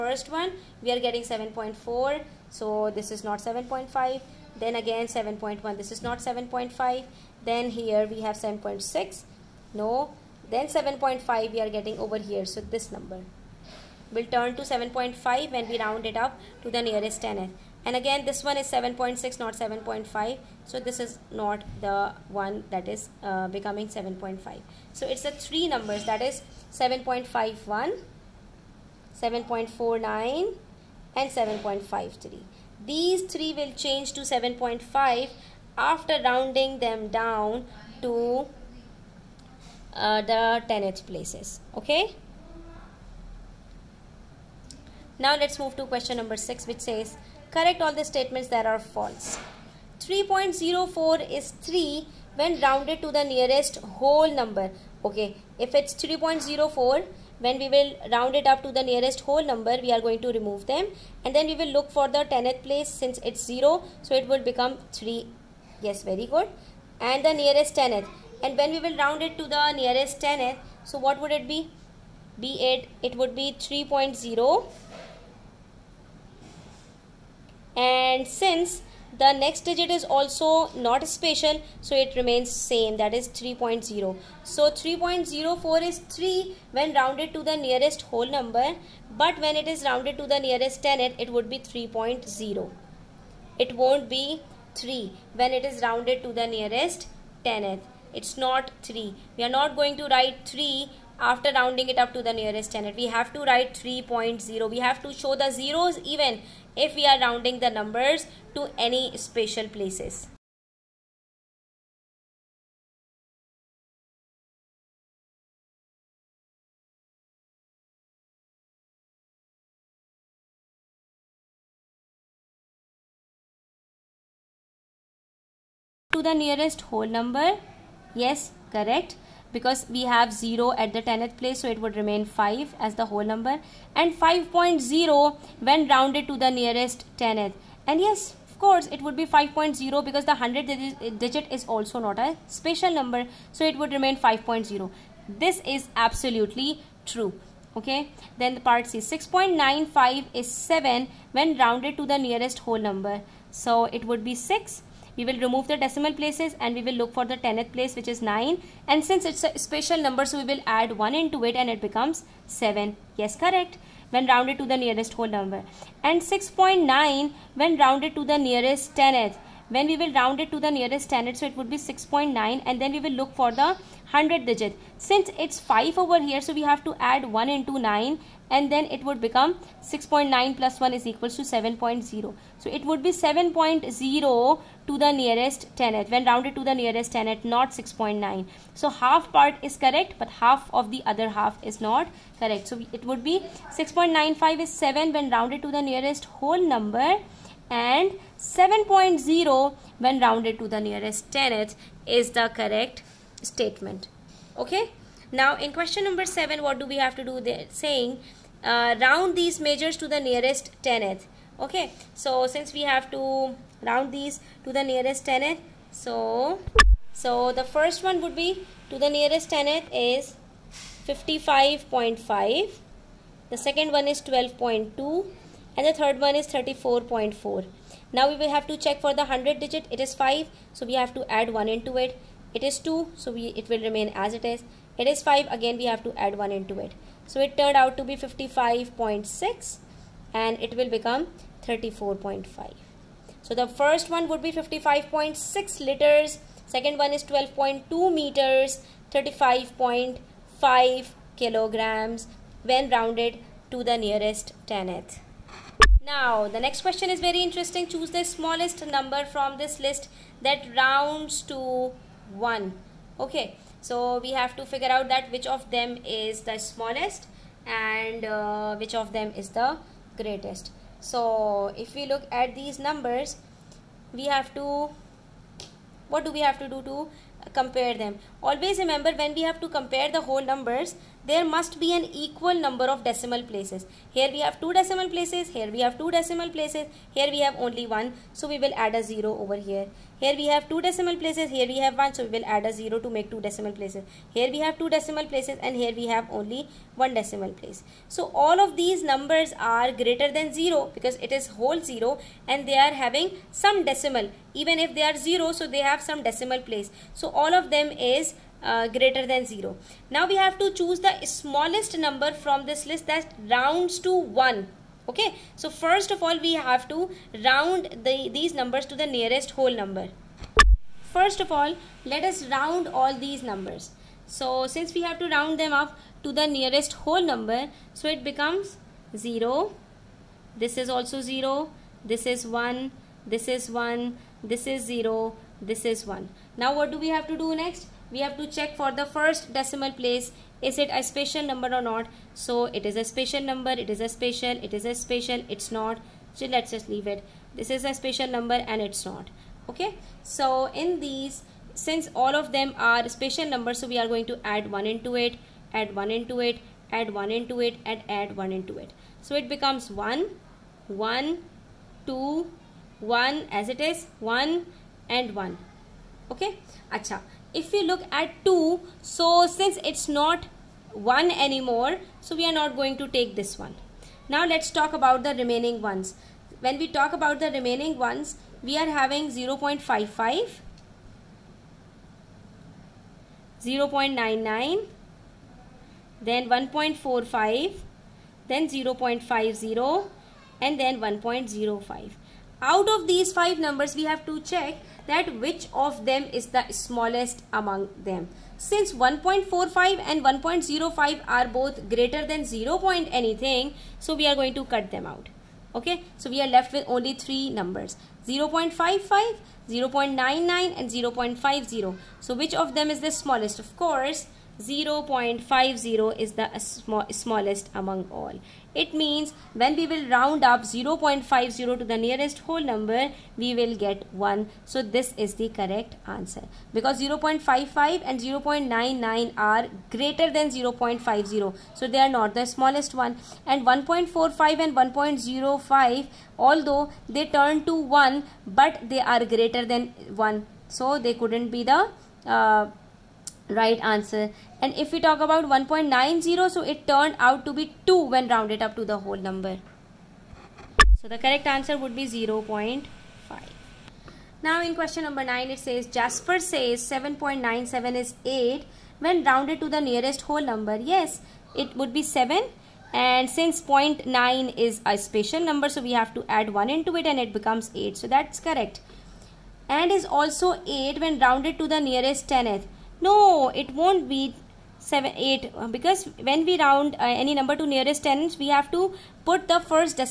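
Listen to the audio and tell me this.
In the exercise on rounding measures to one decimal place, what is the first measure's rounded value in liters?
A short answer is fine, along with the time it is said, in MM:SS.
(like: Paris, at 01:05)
55.6, at 04:04.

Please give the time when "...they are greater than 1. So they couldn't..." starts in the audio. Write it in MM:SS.
07:18.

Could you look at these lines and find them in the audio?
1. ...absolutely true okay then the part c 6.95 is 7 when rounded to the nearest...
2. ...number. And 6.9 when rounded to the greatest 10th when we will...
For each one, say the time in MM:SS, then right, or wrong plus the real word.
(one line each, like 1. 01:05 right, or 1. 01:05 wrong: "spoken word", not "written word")
1. 02:25 right
2. 02:45 wrong: "nearest", not "greatest".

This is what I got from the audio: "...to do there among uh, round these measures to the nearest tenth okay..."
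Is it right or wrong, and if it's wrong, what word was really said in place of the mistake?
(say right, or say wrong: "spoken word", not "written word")
wrong: "saying", not "among".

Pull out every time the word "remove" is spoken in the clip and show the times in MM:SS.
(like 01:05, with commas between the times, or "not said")
01:00, 02:35.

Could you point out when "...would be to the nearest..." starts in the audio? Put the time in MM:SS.
03:38.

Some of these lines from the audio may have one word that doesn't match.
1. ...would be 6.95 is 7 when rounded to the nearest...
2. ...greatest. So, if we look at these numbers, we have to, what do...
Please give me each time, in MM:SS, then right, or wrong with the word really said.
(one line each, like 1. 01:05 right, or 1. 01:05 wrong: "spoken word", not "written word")
1. 03:13 right
2. 04:30 right.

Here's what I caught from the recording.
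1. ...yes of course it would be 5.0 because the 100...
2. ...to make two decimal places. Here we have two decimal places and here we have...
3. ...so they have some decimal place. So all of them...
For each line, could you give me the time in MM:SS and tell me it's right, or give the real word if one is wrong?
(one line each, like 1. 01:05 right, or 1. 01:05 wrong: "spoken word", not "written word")
1. 02:17 right
2. 04:52 right
3. 05:05 right.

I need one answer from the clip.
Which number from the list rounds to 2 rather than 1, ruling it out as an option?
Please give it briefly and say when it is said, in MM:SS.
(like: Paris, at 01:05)
1.90, at 07:25.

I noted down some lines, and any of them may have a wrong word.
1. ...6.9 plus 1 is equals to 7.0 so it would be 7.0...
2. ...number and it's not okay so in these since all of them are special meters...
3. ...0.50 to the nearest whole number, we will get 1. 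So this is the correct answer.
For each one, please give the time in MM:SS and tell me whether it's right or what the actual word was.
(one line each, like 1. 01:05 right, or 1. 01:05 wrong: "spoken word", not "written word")
1. 02:59 right
2. 05:48 wrong: "numbers", not "meters"
3. 07:00 right.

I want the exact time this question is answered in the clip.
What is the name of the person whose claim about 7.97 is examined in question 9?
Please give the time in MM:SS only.
07:35.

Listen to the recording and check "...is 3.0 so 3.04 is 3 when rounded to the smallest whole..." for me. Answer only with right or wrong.
wrong.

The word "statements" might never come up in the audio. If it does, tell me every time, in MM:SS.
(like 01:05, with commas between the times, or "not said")
00:48, 03:23.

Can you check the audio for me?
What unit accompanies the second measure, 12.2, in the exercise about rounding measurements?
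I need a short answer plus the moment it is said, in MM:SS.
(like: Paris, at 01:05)
meters, at 04:07.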